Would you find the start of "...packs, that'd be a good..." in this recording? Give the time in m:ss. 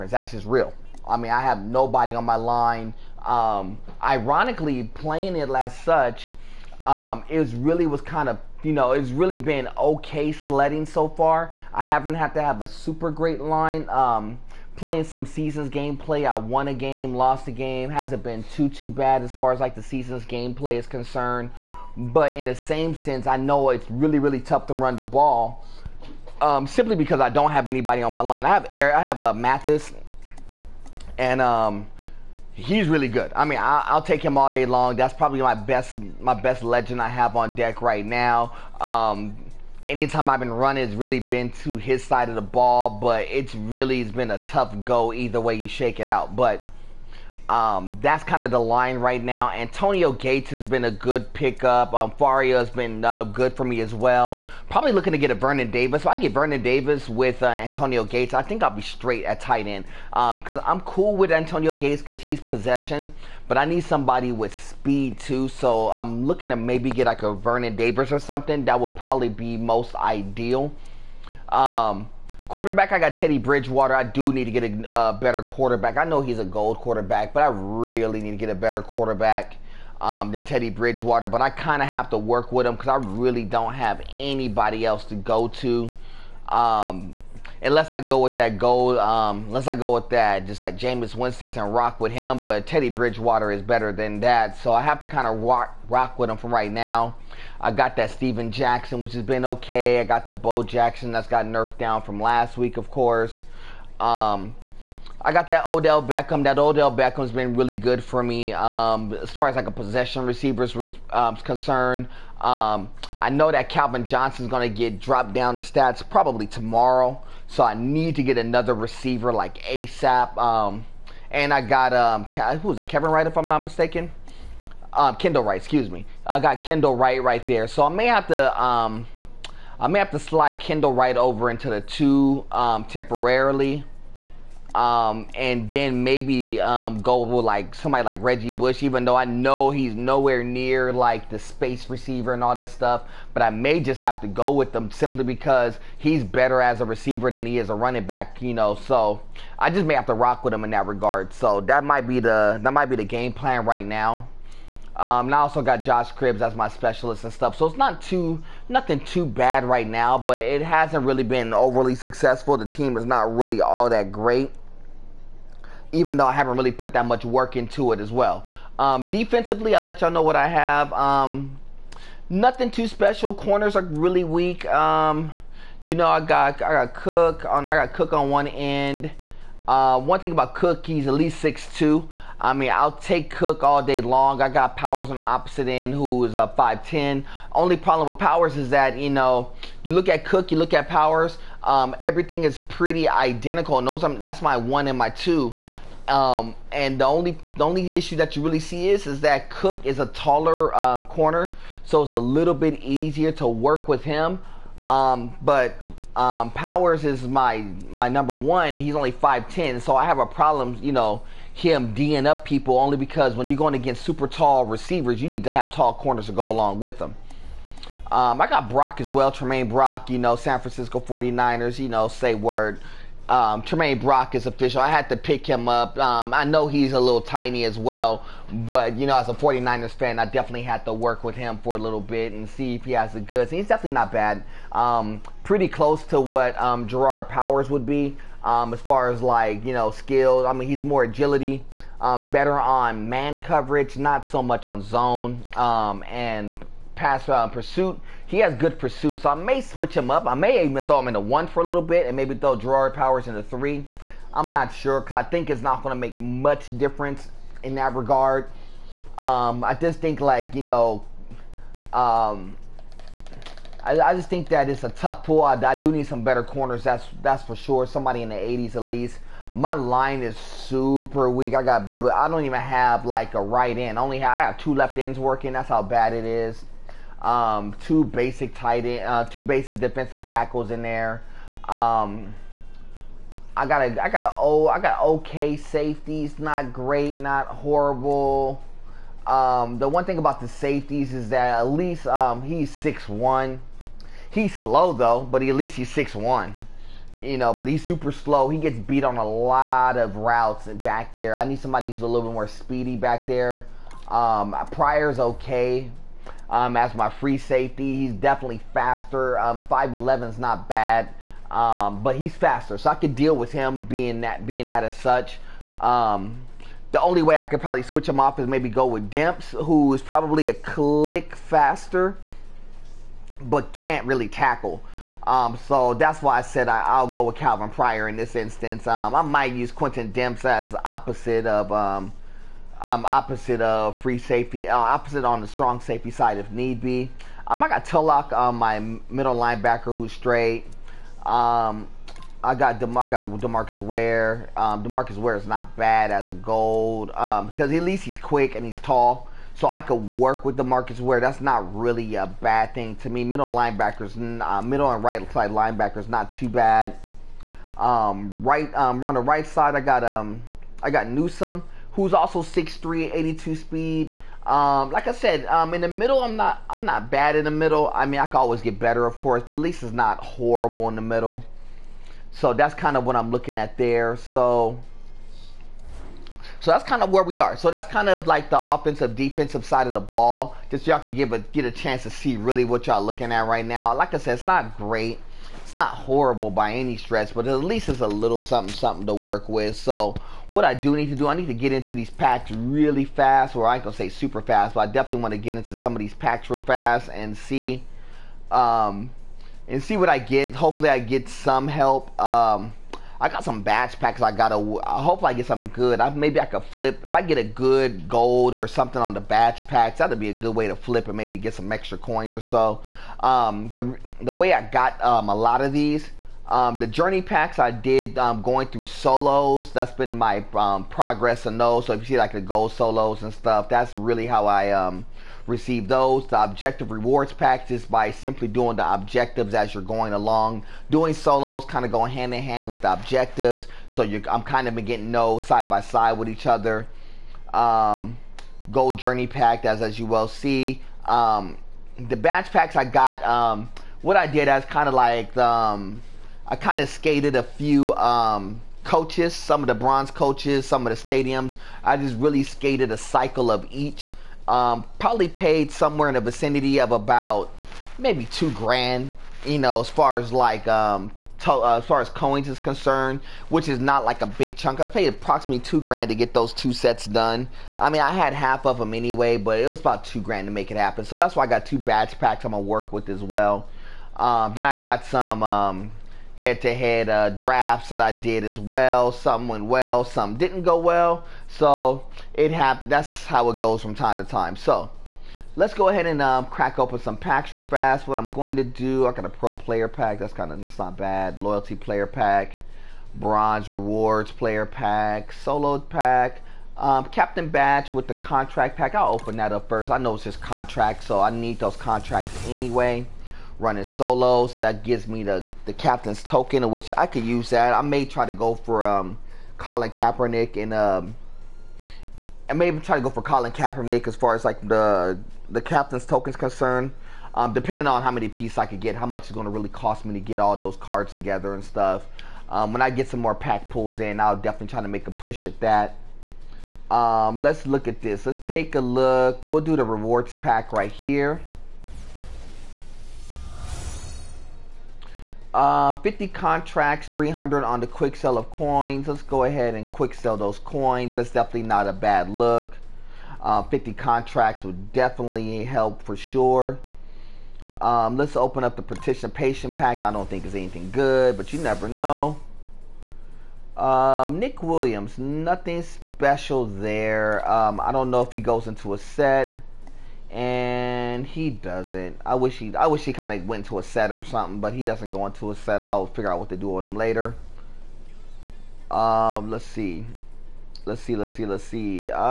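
6:49.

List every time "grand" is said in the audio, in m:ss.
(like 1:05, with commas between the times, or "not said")
7:38, 7:45, 7:50.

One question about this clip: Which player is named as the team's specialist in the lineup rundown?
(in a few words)
Josh Cribbs.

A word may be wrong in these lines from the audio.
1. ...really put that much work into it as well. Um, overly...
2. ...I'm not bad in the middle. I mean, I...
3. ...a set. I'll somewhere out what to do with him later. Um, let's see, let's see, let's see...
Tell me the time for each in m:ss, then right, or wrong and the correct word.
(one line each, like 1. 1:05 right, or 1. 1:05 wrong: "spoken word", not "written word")
1. 2:46 wrong: "defensively", not "overly"
2. 6:06 right
3. 9:25 wrong: "figure", not "somewhere".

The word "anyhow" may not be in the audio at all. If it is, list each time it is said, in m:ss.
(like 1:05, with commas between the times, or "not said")
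not said.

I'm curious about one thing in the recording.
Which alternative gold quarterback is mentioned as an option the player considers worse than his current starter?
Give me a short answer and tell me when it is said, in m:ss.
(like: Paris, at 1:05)
Jameis Winston, at 1:30.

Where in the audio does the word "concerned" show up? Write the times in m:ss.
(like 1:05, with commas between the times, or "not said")
0:20, 1:51, 7:42, 8:36.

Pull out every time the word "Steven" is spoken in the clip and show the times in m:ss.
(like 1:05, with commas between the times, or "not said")
1:38.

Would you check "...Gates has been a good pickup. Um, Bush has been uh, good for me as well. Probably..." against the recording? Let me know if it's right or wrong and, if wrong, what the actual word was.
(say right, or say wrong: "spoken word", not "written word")
wrong: "Fauria", not "Bush".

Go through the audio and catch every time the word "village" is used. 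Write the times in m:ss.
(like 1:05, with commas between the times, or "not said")
not said.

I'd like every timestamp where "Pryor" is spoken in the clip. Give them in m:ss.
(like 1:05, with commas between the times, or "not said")
5:04, 5:27.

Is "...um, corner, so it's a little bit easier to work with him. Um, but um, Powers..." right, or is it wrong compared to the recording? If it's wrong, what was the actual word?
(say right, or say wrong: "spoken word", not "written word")
right.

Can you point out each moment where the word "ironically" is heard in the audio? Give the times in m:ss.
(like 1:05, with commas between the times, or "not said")
0:04.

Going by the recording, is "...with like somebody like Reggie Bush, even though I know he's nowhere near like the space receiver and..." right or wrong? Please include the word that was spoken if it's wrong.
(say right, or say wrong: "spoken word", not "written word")
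right.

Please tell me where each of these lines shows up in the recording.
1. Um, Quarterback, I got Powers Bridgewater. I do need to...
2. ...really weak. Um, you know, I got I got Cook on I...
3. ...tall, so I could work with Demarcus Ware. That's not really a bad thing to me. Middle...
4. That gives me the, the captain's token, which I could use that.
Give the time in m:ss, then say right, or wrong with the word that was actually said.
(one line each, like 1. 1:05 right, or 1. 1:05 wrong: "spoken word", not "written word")
1. 1:11 wrong: "Teddy", not "Powers"
2. 2:53 right
3. 5:48 right
4. 8:24 right.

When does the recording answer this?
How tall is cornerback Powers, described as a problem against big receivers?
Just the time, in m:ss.
3:06.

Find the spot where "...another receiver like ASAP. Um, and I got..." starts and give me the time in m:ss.
1:58.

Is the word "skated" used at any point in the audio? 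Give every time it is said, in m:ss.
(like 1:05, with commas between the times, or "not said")
7:26, 7:32.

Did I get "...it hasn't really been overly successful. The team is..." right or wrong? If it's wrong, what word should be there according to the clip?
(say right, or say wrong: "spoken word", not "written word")
right.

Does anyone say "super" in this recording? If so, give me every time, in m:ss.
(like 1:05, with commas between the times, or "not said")
0:12, 3:34, 4:30, 4:57, 6:34.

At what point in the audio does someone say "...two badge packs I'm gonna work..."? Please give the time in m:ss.
7:51.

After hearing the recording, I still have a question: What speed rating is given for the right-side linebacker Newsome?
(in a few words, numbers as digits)
82.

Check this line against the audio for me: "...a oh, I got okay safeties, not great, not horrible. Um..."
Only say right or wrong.
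right.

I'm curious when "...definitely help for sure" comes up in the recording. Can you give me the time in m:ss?
9:04.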